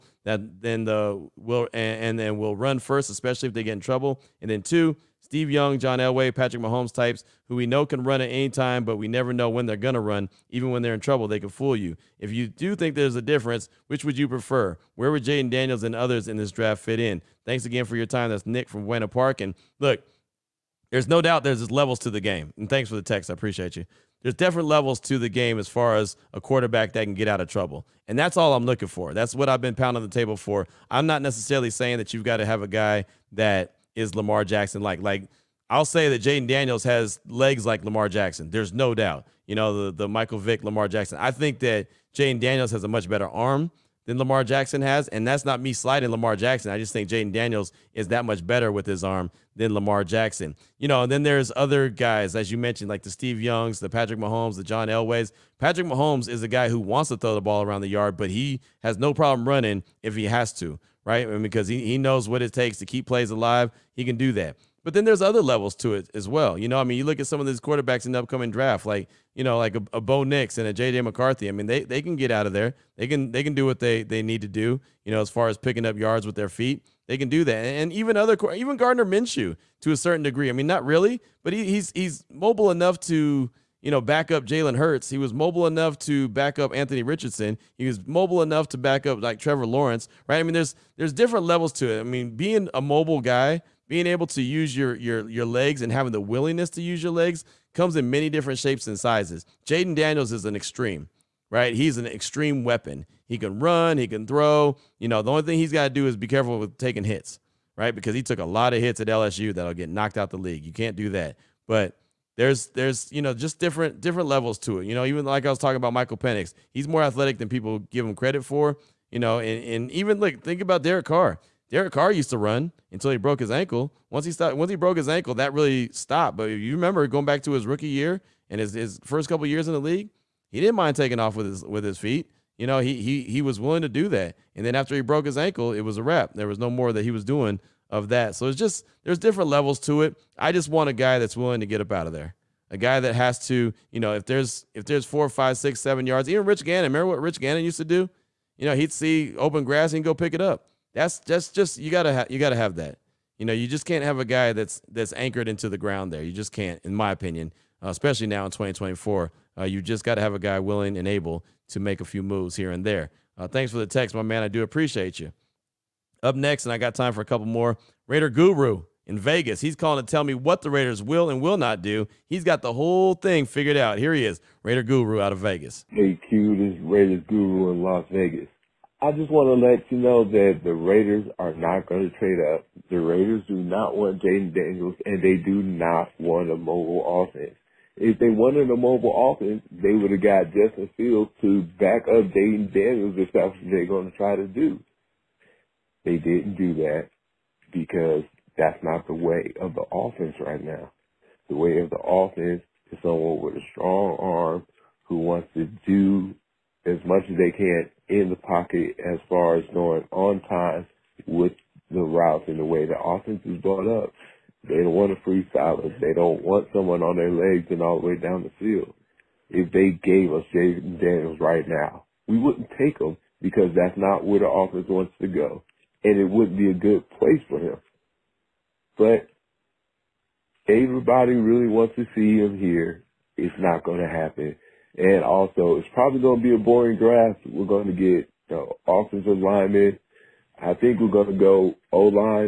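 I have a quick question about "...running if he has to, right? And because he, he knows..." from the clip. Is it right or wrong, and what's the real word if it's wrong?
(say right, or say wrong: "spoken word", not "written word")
right.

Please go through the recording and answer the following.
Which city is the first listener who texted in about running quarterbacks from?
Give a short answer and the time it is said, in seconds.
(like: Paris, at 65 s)
Buena Park, at 18 s.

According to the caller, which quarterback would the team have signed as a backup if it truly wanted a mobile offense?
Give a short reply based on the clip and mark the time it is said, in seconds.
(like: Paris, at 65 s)
Justin Fields, at 190 s.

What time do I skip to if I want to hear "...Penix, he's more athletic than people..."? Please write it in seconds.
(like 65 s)
116 s.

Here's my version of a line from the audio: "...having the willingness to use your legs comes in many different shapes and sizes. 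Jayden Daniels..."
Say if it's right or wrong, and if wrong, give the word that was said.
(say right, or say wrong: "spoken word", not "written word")
right.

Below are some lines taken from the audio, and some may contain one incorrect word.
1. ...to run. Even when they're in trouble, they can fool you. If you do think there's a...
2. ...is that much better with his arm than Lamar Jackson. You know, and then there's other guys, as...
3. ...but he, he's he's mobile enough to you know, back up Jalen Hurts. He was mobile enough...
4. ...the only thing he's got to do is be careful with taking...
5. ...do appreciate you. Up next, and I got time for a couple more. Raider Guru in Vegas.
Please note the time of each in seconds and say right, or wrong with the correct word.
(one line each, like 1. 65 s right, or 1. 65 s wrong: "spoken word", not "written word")
1. 9 s right
2. 47 s right
3. 81 s right
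4. 105 s right
5. 164 s right.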